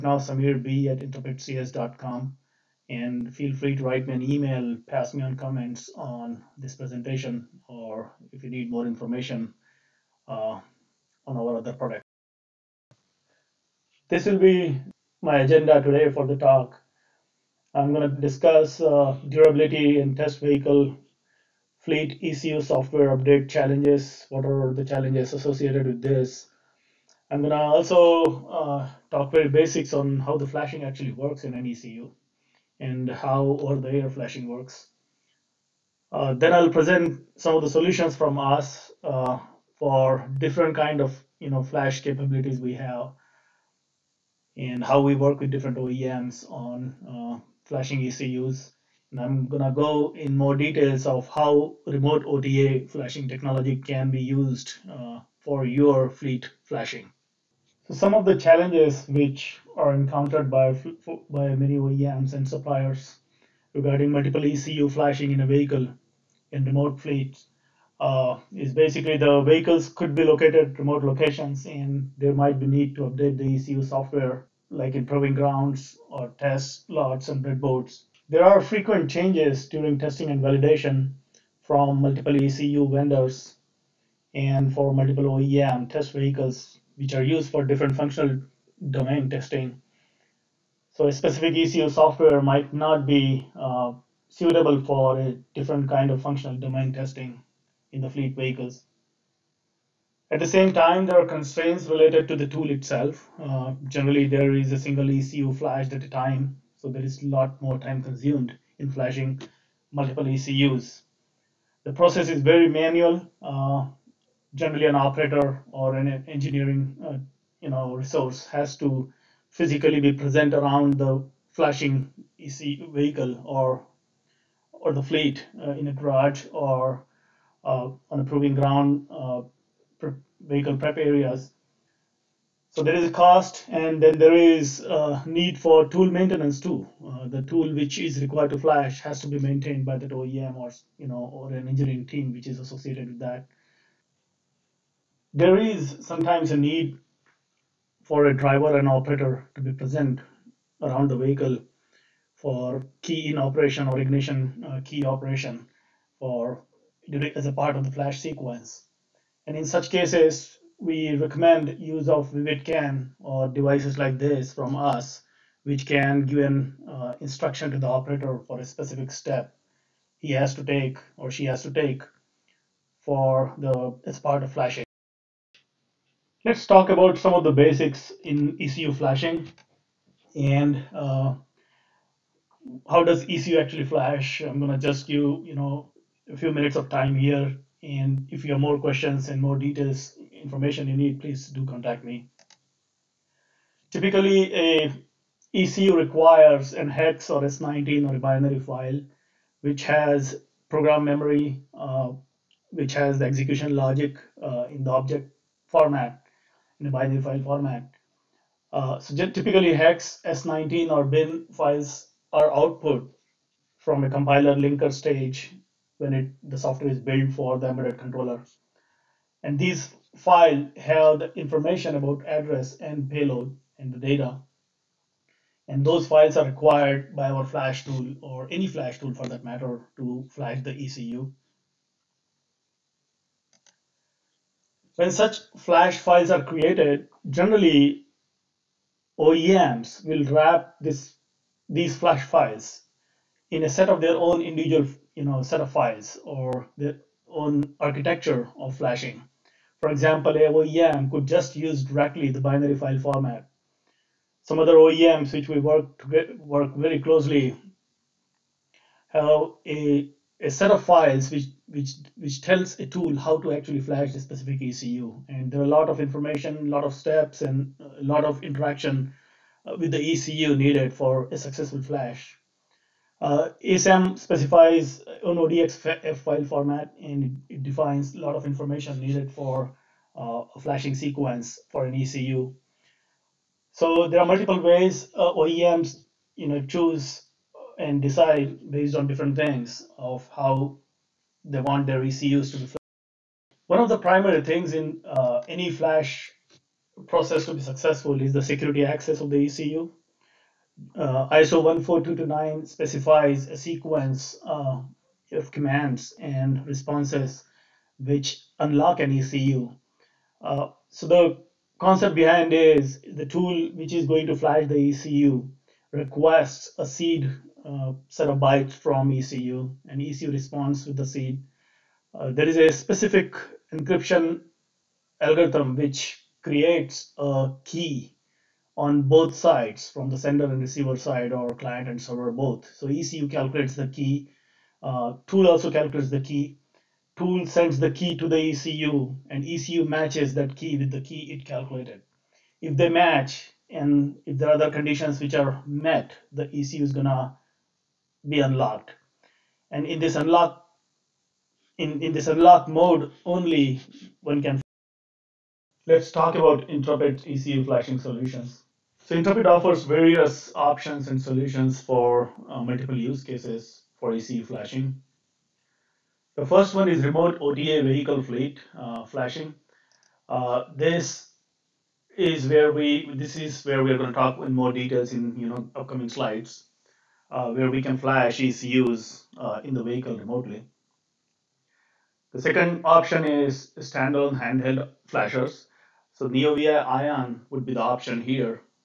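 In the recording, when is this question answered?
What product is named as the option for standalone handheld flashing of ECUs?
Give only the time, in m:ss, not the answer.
6:26.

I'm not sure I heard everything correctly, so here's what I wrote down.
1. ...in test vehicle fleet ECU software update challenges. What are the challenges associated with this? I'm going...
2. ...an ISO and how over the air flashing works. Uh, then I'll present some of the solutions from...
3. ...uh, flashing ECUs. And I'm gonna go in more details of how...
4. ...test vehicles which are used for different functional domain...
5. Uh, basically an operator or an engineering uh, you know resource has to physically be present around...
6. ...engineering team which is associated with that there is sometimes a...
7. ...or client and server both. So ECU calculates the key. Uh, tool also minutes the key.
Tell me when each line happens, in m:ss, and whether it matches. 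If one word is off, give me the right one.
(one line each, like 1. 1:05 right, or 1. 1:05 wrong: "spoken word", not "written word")
1. 0:19 right
2. 0:31 wrong: "ECU", not "ISO"
3. 0:47 right
4. 1:25 right
5. 1:53 wrong: "generally", not "basically"
6. 2:21 right
7. 5:31 wrong: "calculates", not "minutes".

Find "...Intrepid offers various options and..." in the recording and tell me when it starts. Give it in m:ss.
5:59.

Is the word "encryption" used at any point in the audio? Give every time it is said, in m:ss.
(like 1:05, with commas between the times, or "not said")
5:23.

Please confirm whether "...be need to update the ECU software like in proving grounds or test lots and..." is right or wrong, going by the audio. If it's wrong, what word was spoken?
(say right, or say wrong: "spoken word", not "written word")
right.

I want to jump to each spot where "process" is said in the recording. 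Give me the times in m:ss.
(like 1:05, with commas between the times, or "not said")
1:51, 4:57.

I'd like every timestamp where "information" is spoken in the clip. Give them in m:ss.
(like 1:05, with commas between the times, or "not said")
0:08, 3:10, 3:41, 4:26, 4:38.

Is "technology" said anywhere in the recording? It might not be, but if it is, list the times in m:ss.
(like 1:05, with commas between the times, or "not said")
0:53.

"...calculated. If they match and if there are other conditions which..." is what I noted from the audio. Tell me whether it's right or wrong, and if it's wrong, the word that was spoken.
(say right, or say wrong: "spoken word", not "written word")
right.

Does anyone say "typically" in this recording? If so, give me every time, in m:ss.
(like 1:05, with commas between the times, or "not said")
3:13, 3:29.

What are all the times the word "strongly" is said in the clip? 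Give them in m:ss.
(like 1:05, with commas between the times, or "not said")
not said.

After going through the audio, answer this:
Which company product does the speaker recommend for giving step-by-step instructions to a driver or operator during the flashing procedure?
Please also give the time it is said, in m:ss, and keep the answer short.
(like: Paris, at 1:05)
VividCAN, at 2:42.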